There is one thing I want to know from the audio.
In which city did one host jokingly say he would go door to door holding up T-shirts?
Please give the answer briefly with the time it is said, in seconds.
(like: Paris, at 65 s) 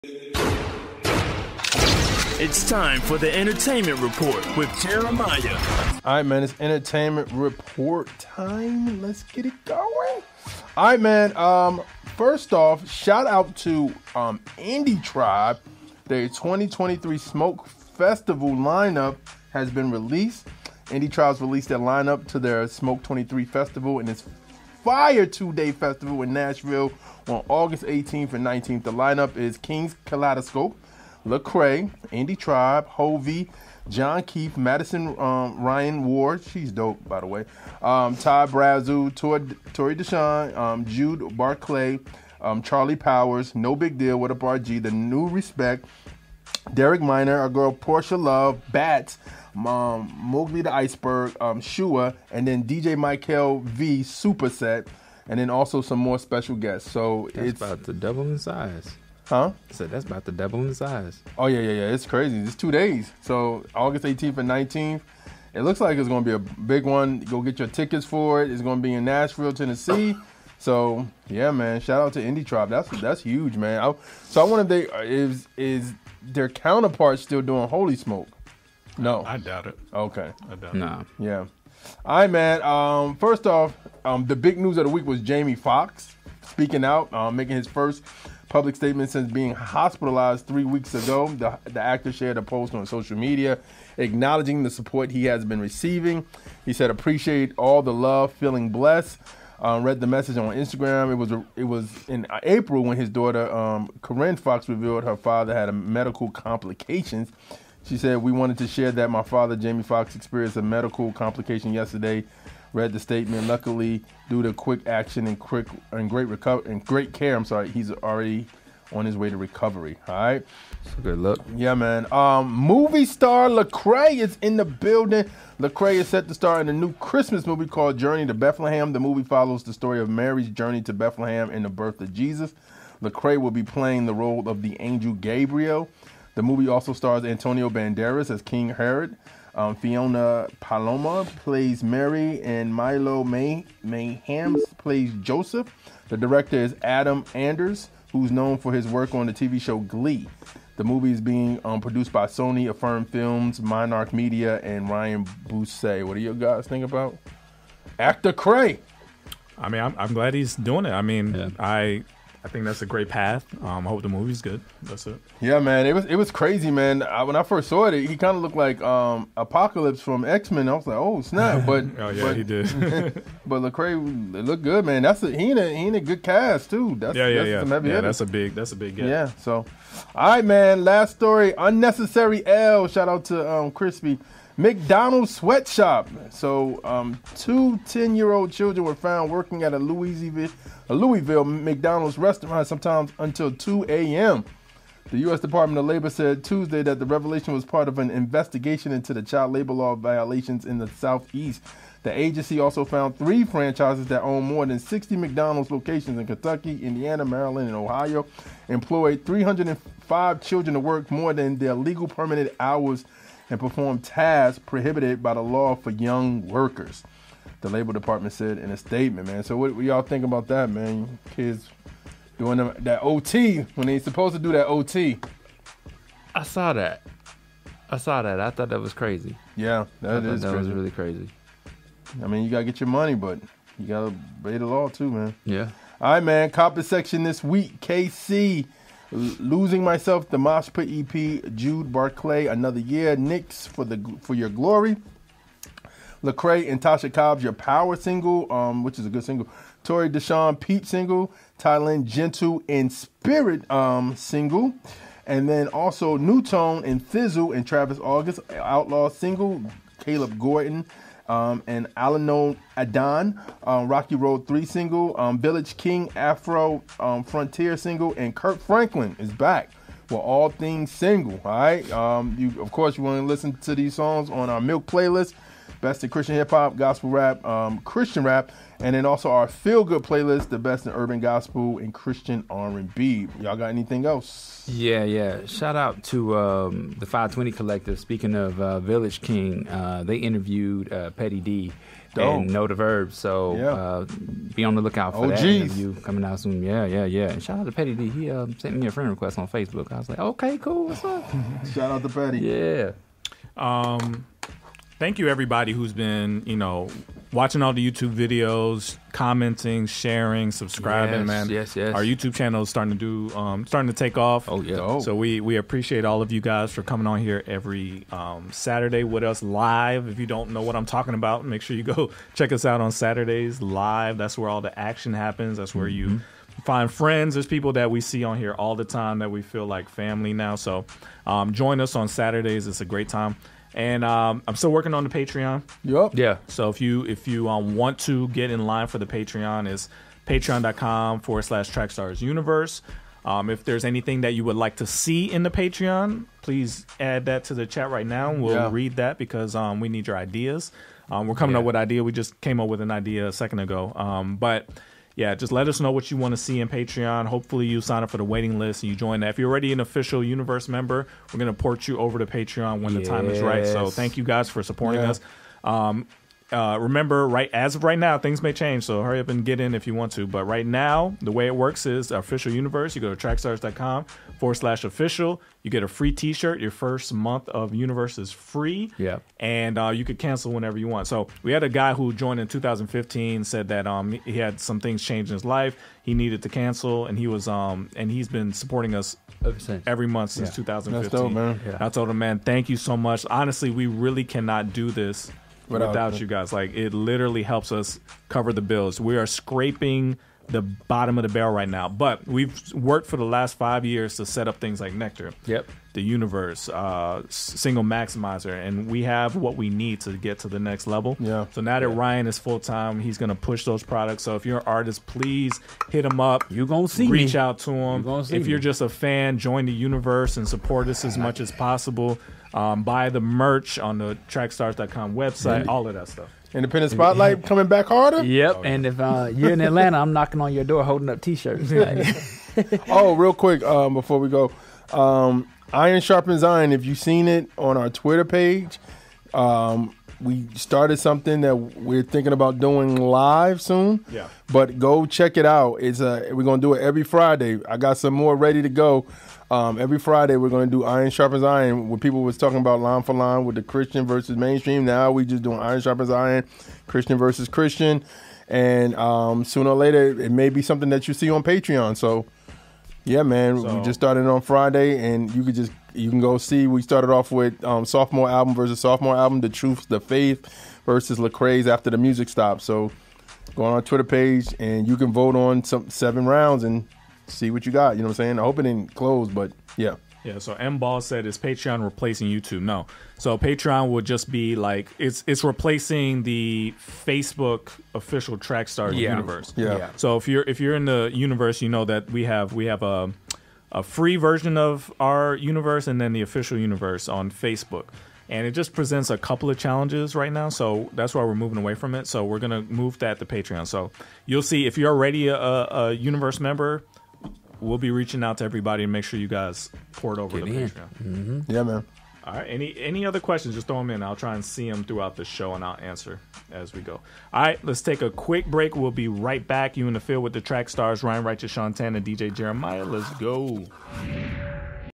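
Atlanta, at 429 s.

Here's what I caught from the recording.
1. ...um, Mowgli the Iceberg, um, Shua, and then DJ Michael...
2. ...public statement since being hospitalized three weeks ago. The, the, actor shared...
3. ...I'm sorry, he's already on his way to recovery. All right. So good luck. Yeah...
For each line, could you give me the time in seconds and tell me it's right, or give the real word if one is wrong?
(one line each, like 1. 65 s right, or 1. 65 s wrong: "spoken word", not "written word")
1. 50 s right
2. 88 s right
3. 117 s right.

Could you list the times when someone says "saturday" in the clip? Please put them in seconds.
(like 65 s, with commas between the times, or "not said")
318 s, 322 s, 332 s.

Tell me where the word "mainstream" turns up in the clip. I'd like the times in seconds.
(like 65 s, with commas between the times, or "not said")
454 s.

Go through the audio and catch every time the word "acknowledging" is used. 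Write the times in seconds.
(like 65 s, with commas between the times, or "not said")
93 s.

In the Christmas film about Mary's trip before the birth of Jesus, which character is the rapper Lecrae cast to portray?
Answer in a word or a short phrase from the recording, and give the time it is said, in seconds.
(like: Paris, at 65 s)
Angel Gabriel, at 134 s.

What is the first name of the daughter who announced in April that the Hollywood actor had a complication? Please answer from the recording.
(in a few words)
Corinne.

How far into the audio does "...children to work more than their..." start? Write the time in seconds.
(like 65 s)
210 s.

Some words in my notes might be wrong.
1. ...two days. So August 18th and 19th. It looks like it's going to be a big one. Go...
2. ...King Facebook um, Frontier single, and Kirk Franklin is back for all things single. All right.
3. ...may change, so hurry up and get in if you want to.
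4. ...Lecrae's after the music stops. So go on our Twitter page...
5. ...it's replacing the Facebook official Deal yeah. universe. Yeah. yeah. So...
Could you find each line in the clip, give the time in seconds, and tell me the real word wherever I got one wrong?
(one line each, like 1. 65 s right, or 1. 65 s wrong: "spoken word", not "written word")
1. 62 s right
2. 265 s wrong: "Afro", not "Facebook"
3. 368 s right
4. 471 s right
5. 485 s wrong: "Trackstar", not "Deal".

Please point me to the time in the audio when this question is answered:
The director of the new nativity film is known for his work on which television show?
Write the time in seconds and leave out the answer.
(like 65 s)
149 s.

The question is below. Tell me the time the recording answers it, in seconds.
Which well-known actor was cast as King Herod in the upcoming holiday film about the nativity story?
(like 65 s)
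137 s.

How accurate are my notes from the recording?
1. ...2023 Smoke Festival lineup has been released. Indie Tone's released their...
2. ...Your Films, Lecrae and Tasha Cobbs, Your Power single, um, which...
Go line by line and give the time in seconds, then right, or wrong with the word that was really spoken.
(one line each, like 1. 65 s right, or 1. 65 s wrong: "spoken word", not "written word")
1. 16 s wrong: "Tribe", not "Tone"
2. 244 s wrong: "Glory", not "Films".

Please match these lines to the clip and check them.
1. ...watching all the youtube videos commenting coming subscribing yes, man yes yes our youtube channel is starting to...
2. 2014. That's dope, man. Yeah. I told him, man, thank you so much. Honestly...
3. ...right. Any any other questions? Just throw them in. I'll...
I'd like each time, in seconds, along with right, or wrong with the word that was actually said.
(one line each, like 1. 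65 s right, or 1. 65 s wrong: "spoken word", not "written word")
1. 307 s wrong: "sharing", not "coming"
2. 390 s wrong: "2015", not "2014"
3. 512 s right.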